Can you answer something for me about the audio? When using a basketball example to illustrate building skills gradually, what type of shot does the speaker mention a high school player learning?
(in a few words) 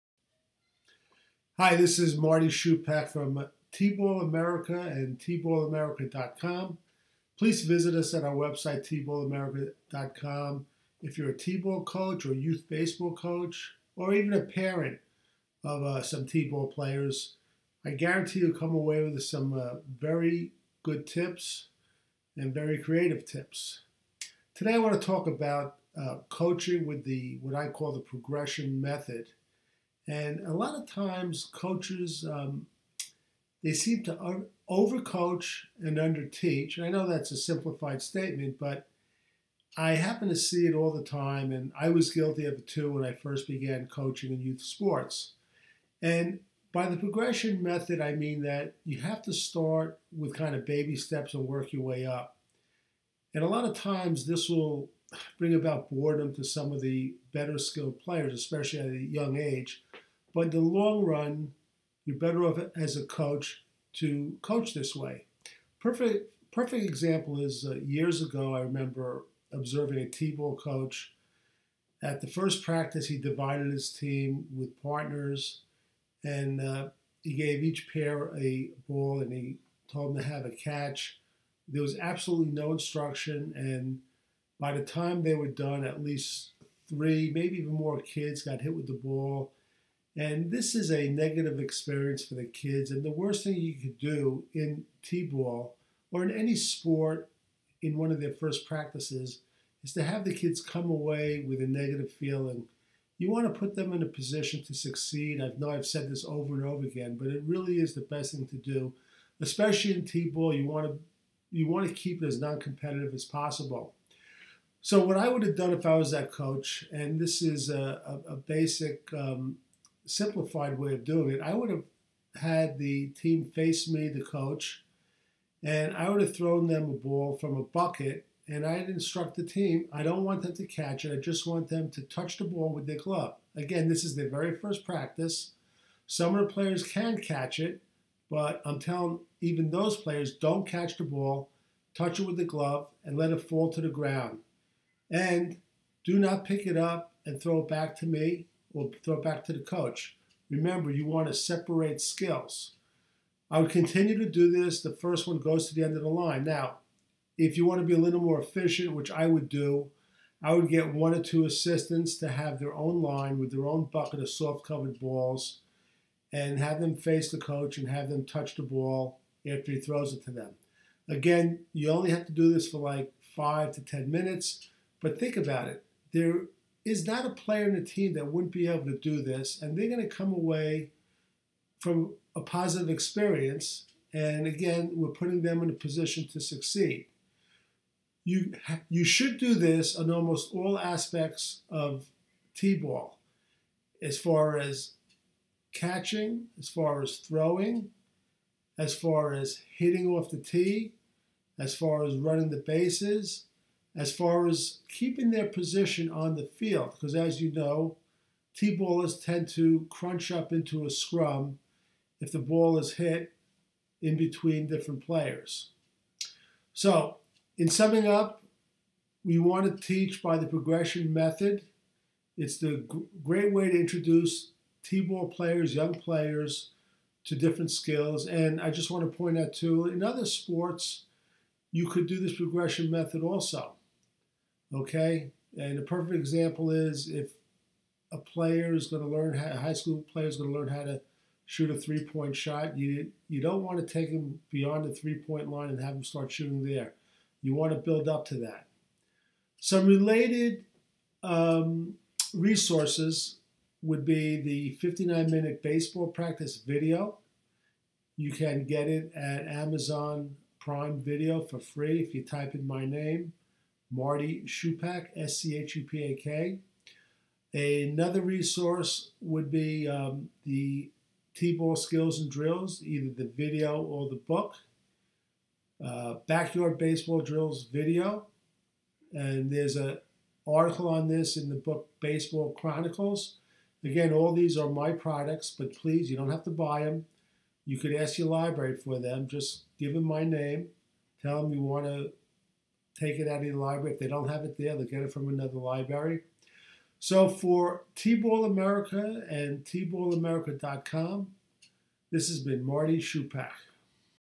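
three point shot.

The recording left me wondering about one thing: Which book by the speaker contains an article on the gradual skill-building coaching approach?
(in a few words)
Baseball Chronicles.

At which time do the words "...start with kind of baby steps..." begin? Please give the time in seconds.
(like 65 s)
49 s.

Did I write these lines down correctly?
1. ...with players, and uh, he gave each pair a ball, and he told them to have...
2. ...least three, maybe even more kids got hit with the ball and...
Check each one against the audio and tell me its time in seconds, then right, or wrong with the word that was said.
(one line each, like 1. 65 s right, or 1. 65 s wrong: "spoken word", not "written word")
1. 74 s wrong: "partners", not "players"
2. 86 s right.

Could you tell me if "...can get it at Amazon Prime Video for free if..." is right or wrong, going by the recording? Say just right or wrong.
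right.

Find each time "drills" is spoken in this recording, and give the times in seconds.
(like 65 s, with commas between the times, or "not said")
272 s, 277 s.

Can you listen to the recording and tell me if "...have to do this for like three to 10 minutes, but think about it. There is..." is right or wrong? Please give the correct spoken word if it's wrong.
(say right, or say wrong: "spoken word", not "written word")
wrong: "five", not "three".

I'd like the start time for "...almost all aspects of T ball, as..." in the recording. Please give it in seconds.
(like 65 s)
190 s.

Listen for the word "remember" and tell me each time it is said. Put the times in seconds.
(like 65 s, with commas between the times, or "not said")
68 s, 150 s.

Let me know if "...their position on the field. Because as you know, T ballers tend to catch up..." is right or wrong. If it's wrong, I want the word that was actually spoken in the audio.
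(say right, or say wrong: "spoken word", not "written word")
wrong: "crunch", not "catch".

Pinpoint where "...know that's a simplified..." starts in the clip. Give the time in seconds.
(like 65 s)
36 s.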